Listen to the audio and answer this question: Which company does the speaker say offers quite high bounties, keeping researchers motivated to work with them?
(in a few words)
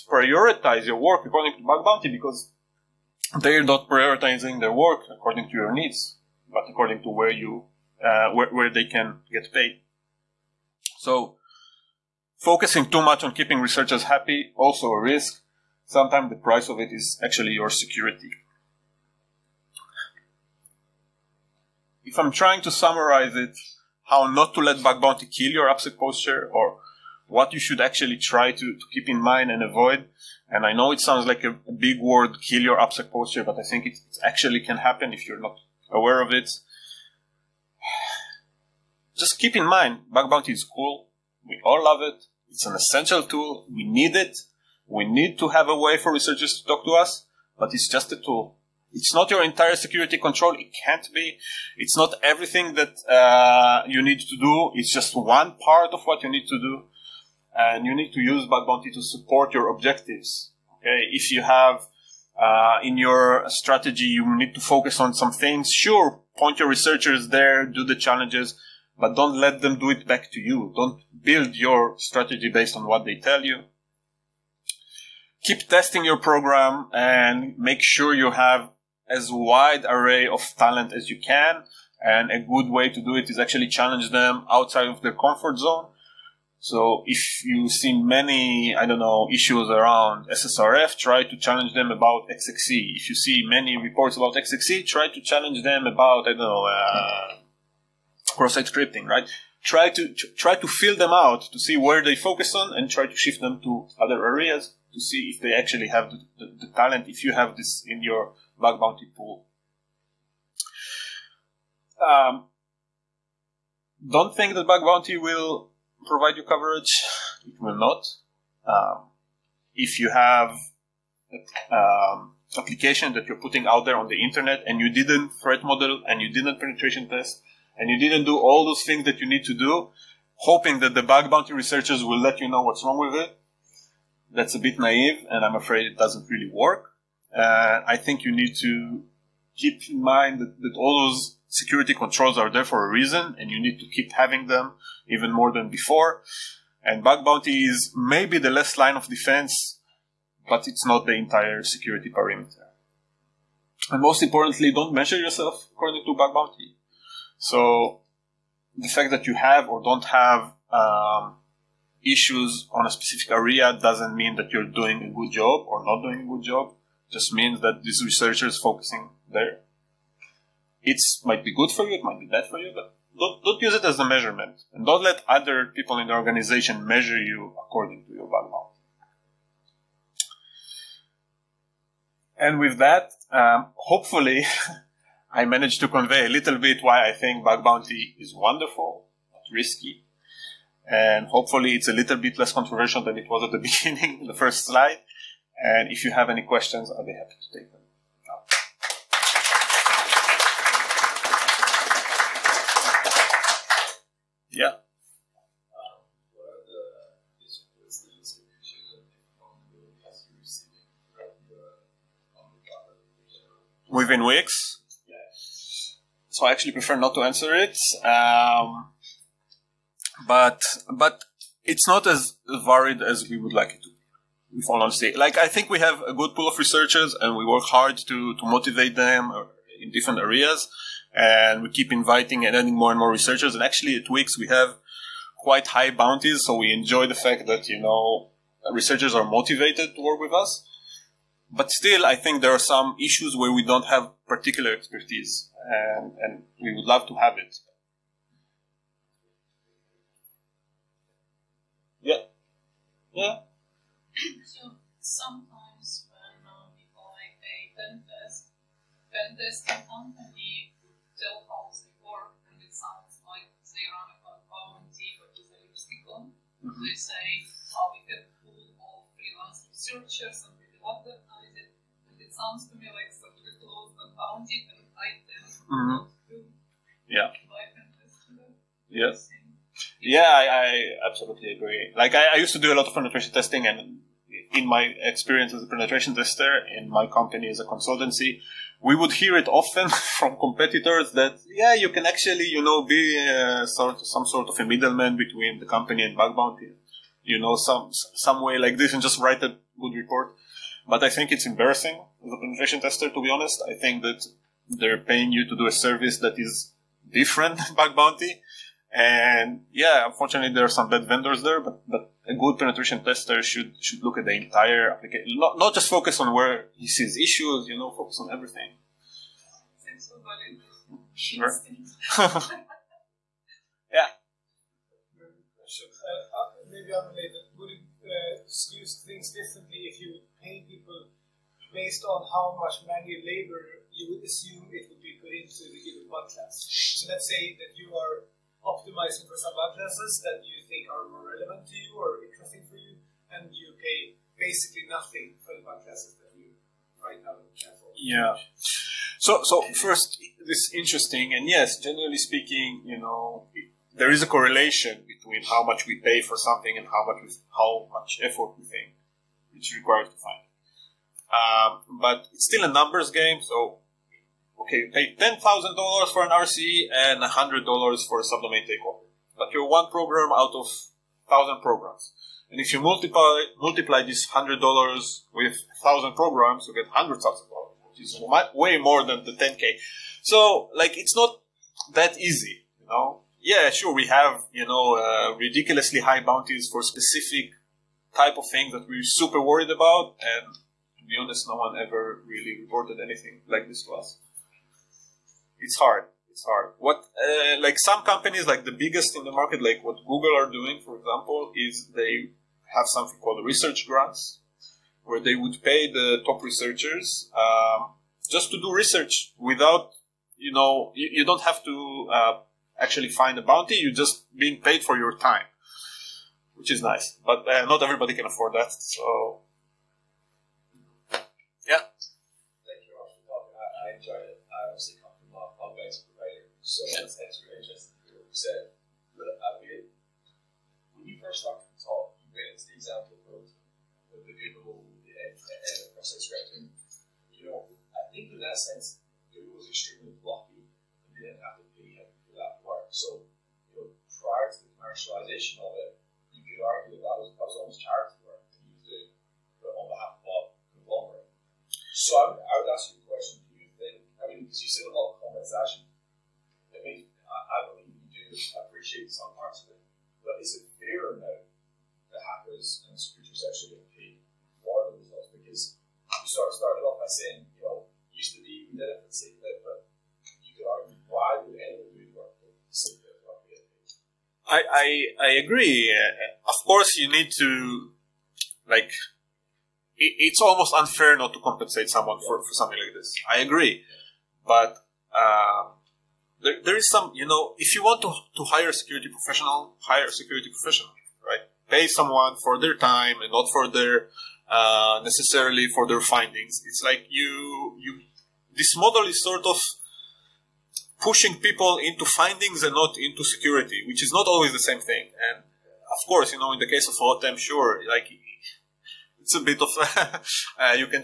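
Wix.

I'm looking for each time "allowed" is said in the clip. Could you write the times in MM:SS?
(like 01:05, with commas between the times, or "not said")
not said.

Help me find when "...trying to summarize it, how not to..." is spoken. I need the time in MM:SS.
00:22.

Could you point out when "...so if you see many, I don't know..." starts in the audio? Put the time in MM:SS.
01:26.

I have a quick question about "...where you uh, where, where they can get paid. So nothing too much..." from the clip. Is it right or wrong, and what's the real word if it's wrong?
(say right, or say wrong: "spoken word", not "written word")
wrong: "focusing", not "nothing".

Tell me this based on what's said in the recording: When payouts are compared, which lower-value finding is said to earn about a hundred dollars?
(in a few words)
subdomain takeover.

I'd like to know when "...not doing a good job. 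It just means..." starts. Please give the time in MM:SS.
02:45.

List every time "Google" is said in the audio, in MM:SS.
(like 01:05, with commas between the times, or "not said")
06:40, 07:14, 07:19.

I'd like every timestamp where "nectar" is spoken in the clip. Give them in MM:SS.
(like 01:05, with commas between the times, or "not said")
not said.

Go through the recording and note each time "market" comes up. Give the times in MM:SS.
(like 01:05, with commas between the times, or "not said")
06:39.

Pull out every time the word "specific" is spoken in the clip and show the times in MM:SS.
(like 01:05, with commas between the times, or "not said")
02:42, 06:26.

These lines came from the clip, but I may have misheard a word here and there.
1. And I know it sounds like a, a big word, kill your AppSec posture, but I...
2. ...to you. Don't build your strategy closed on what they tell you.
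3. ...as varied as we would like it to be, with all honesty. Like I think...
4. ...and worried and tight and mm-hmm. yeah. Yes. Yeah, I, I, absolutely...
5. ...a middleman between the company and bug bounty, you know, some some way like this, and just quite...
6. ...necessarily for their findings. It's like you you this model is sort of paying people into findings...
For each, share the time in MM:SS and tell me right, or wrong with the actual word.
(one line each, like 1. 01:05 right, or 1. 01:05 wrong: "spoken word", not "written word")
1. 00:30 right
2. 01:10 wrong: "based", not "closed"
3. 03:42 right
4. 04:34 wrong: "bounded", not "worried"
5. 04:54 wrong: "write", not "quite"
6. 08:15 wrong: "pushing", not "paying".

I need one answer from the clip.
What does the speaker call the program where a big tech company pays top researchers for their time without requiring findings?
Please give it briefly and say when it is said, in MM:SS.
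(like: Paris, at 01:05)
research grants, at 06:43.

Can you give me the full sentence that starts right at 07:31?
So I would, I would ask you a question.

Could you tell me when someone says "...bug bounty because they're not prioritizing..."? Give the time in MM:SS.
00:01.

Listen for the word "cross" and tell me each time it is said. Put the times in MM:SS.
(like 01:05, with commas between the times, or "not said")
01:38, 07:15.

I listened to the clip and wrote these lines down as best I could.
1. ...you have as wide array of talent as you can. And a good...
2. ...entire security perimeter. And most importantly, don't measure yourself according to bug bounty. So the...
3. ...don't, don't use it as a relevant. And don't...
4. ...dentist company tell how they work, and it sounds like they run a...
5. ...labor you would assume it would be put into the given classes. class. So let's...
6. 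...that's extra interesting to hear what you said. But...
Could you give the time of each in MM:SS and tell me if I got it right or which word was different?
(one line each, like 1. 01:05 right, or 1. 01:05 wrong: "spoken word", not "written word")
1. 01:18 right
2. 02:31 right
3. 02:53 wrong: "measurement", not "relevant"
4. 04:19 right
5. 05:33 right
6. 07:06 right.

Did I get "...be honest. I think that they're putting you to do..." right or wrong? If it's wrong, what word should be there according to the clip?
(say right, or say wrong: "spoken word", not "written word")
wrong: "paying", not "putting".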